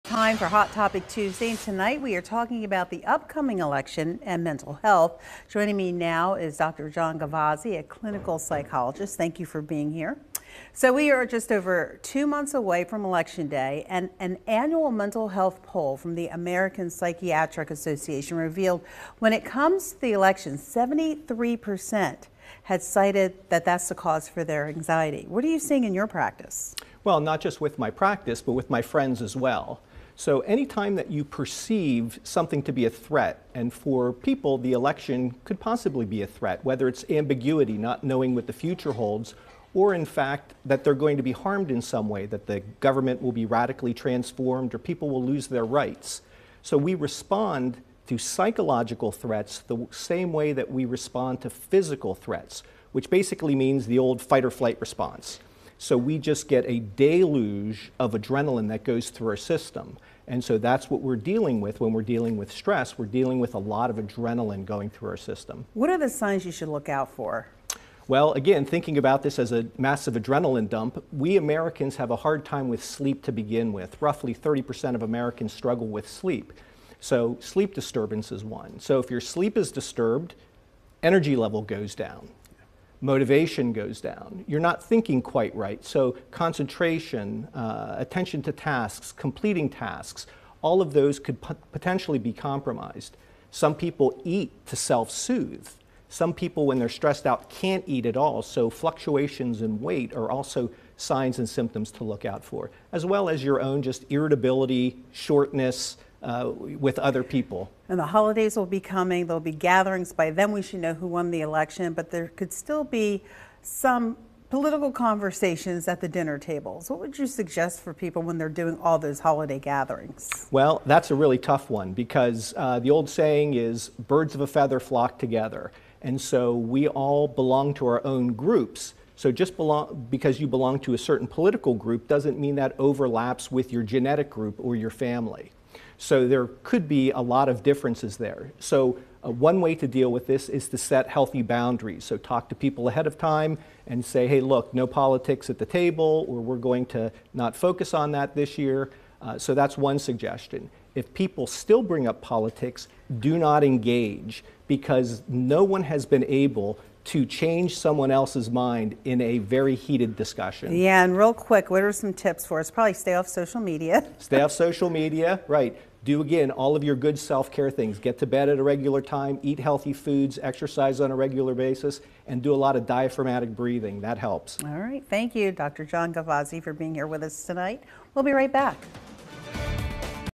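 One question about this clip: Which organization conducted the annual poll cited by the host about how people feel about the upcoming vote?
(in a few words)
American Psychiatric Association.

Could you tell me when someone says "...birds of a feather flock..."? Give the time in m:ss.
2:04.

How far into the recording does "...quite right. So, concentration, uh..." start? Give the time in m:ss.
1:25.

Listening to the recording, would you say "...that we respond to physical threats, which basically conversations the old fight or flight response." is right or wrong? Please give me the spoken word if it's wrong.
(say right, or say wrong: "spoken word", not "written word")
wrong: "means", not "conversations".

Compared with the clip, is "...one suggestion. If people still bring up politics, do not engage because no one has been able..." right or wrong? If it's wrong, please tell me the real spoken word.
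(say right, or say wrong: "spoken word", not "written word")
right.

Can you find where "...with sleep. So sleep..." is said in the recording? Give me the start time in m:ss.
1:15.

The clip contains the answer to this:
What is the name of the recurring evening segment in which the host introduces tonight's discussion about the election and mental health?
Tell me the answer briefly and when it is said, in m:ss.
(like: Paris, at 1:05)
Hot Topic Tuesday, at 0:00.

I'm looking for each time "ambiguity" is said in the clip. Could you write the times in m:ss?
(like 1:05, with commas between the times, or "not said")
0:37.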